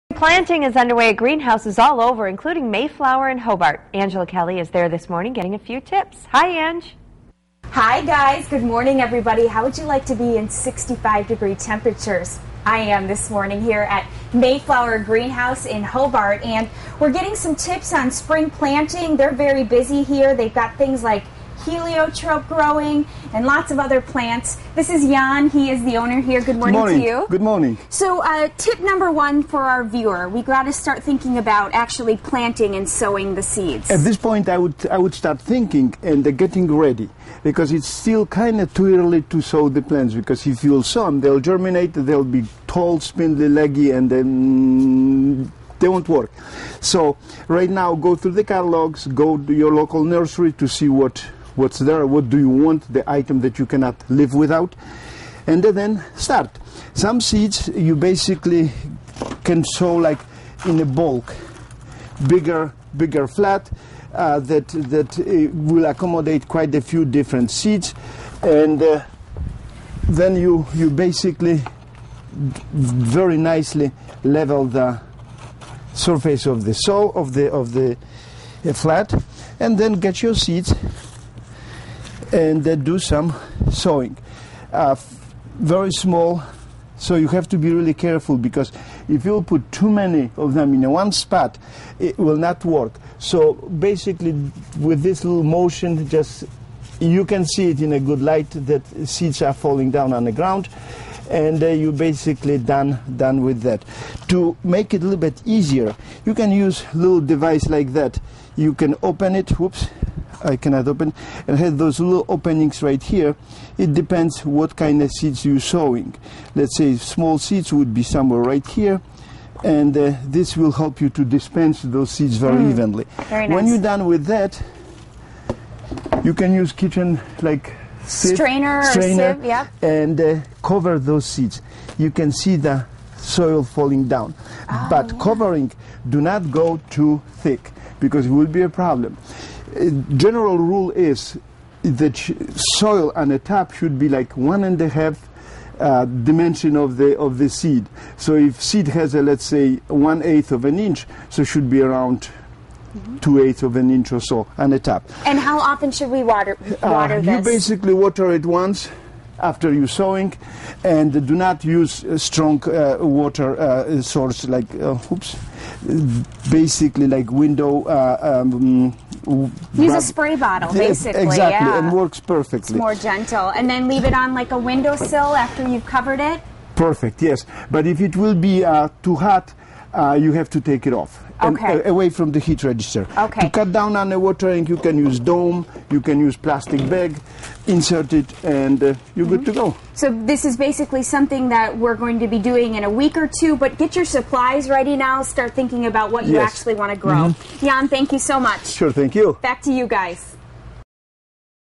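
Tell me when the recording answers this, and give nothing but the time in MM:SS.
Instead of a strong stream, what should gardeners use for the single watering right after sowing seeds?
02:50.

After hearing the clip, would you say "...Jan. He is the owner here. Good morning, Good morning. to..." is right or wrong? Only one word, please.
right.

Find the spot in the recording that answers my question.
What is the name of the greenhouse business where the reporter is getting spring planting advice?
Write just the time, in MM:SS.
00:14.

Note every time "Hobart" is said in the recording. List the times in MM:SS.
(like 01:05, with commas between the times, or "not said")
00:03, 00:15.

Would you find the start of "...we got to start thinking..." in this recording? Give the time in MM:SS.
00:30.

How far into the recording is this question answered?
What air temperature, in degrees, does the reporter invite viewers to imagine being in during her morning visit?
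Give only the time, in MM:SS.
00:10.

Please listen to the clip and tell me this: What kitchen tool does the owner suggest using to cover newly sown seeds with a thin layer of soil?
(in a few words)
strainer sieve.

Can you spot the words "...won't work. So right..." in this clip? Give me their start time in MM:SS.
00:45.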